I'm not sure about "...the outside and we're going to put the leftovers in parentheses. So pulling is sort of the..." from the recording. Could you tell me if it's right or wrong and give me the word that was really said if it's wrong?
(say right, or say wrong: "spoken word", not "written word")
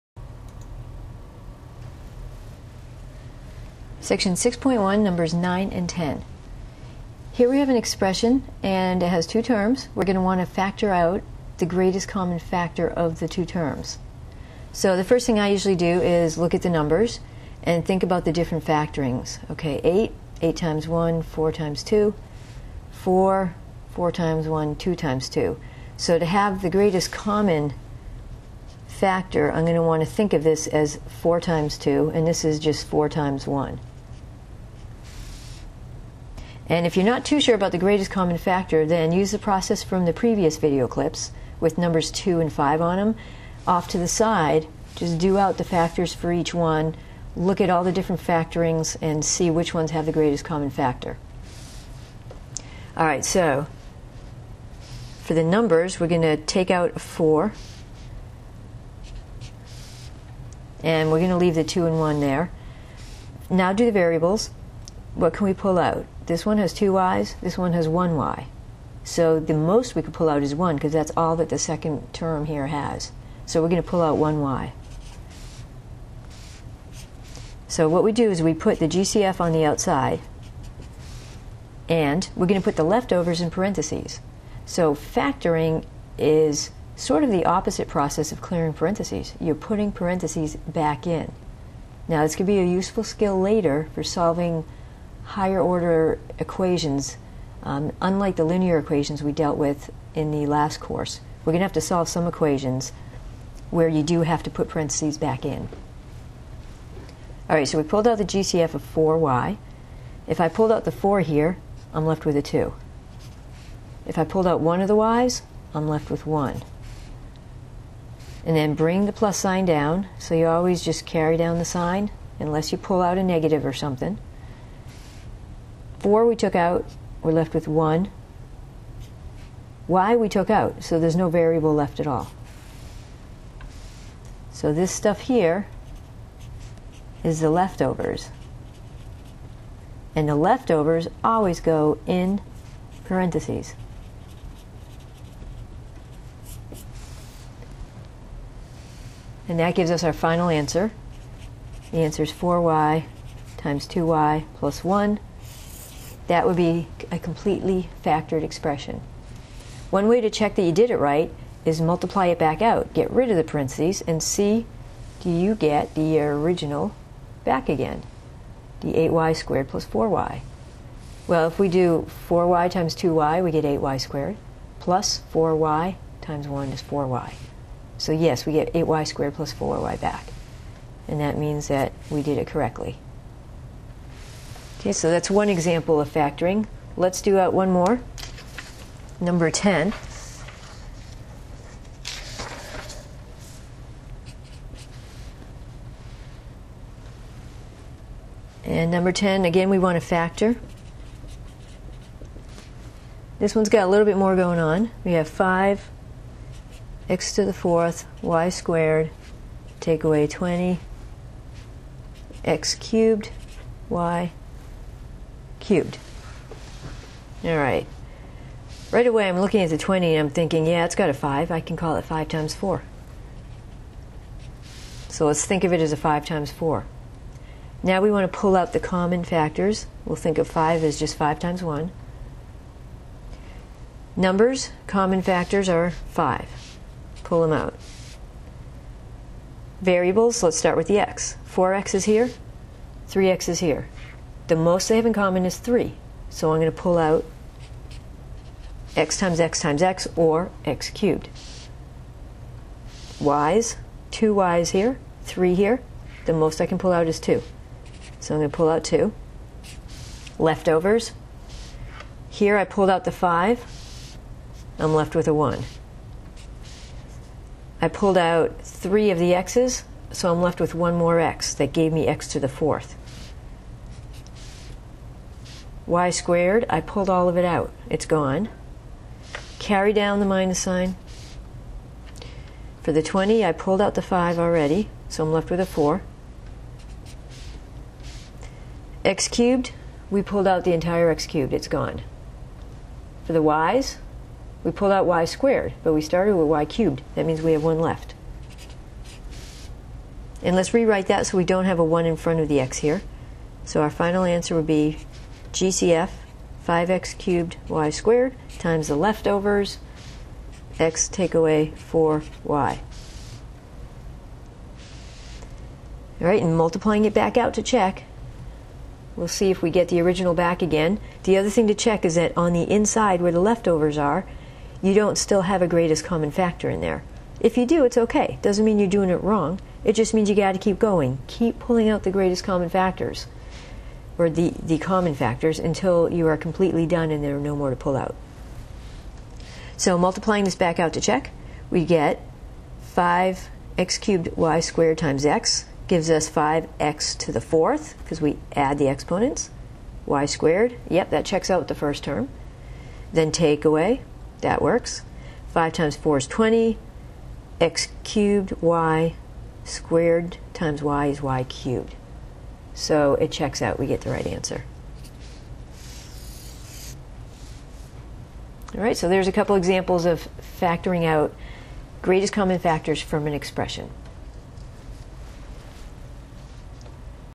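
wrong: "factoring", not "pulling".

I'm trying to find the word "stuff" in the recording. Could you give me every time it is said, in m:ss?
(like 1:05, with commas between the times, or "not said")
2:14.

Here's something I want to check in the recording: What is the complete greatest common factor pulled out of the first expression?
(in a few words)
4y.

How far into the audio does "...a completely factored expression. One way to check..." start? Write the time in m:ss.
2:37.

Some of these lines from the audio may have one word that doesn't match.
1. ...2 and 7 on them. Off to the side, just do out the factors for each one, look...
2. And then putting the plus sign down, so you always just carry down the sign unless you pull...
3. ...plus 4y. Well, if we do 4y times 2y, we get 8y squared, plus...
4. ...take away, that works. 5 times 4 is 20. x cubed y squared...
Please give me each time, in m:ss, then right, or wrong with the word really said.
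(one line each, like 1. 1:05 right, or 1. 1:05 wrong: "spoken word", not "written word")
1. 0:42 wrong: "5", not "7"
2. 1:58 wrong: "bring", not "putting"
3. 2:49 right
4. 5:53 right.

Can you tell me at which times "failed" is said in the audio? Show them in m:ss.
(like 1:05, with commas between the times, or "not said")
not said.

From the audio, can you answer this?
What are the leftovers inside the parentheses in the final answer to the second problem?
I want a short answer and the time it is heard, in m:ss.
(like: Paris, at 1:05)
x - 4y, at 5:10.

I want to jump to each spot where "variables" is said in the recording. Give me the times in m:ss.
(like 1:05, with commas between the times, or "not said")
1:03, 2:11, 3:59.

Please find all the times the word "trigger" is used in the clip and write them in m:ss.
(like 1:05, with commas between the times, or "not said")
not said.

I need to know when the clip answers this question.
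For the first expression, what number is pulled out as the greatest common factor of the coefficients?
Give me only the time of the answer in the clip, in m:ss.
0:55.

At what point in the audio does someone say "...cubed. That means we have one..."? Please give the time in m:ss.
4:56.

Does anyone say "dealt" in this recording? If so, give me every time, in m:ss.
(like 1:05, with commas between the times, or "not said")
1:39.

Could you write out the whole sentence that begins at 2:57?
So, yes, we get 8y squared plus 4y back.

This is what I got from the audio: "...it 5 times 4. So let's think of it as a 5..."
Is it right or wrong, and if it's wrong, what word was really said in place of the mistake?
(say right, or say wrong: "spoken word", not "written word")
right.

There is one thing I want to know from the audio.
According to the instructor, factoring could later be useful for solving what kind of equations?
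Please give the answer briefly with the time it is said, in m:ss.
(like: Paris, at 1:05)
higher order equations, at 1:35.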